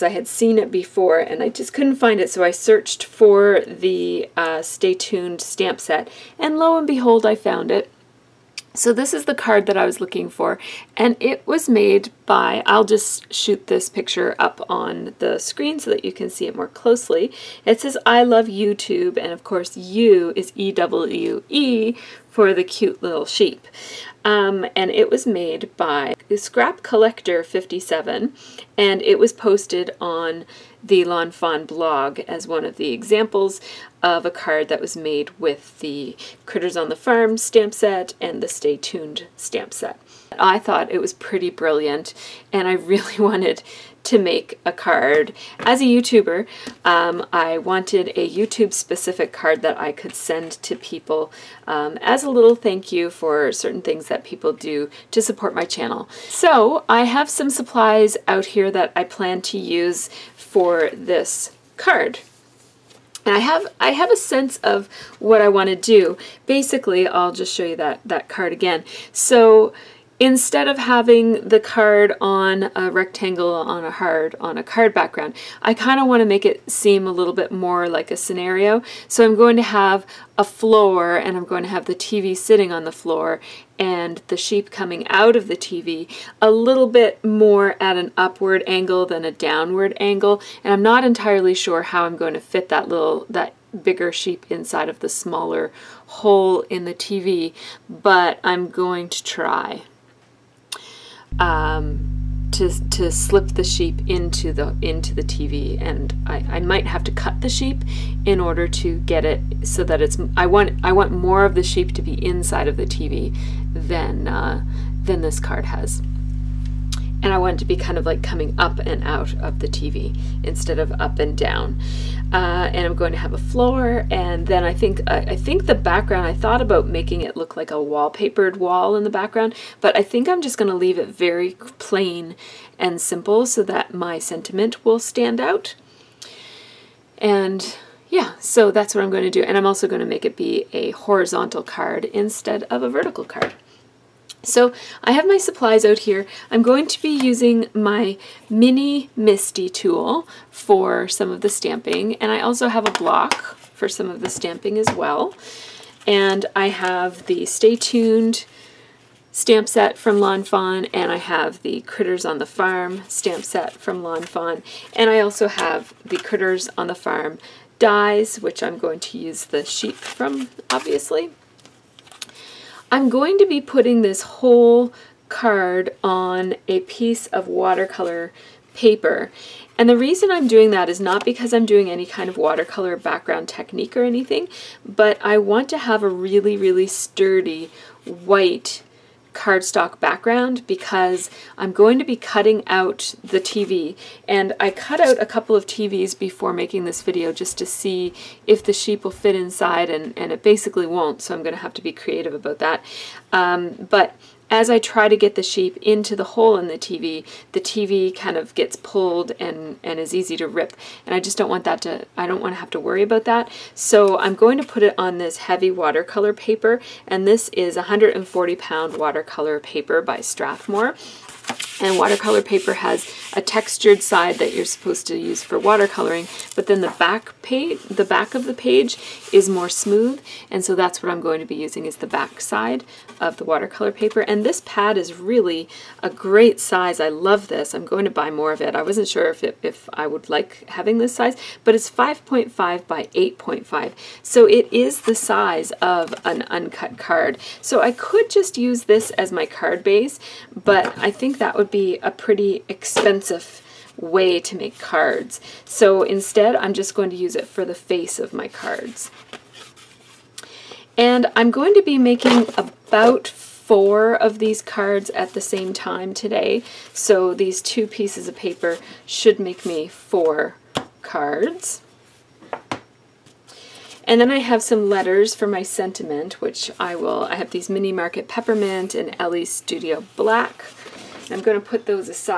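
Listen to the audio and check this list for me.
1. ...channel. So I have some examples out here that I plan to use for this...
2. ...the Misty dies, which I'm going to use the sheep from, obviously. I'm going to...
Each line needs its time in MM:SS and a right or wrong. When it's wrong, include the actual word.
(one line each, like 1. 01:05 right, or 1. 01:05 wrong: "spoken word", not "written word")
1. 00:55 wrong: "supplies", not "examples"
2. 02:46 wrong: "Farm", not "Misty".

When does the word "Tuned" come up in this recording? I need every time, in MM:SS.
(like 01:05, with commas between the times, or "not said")
00:04, 00:38, 02:37.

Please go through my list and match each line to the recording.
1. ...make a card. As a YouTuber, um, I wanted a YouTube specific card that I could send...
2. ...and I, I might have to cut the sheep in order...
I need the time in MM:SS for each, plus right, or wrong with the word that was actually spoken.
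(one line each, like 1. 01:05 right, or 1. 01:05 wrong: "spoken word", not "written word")
1. 00:44 right
2. 01:45 right.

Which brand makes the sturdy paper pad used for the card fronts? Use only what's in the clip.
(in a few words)
Strathmore.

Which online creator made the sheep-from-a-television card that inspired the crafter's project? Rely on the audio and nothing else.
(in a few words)
ScrapCollectr57.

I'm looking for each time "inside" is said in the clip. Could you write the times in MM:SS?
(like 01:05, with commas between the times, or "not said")
01:34, 01:52, 03:19.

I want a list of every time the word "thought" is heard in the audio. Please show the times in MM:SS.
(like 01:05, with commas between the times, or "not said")
00:40, 02:06.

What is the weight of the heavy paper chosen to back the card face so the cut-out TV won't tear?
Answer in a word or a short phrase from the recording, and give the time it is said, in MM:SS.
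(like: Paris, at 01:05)
140 pound, at 03:37.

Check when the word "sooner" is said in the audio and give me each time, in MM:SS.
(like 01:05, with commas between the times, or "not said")
not said.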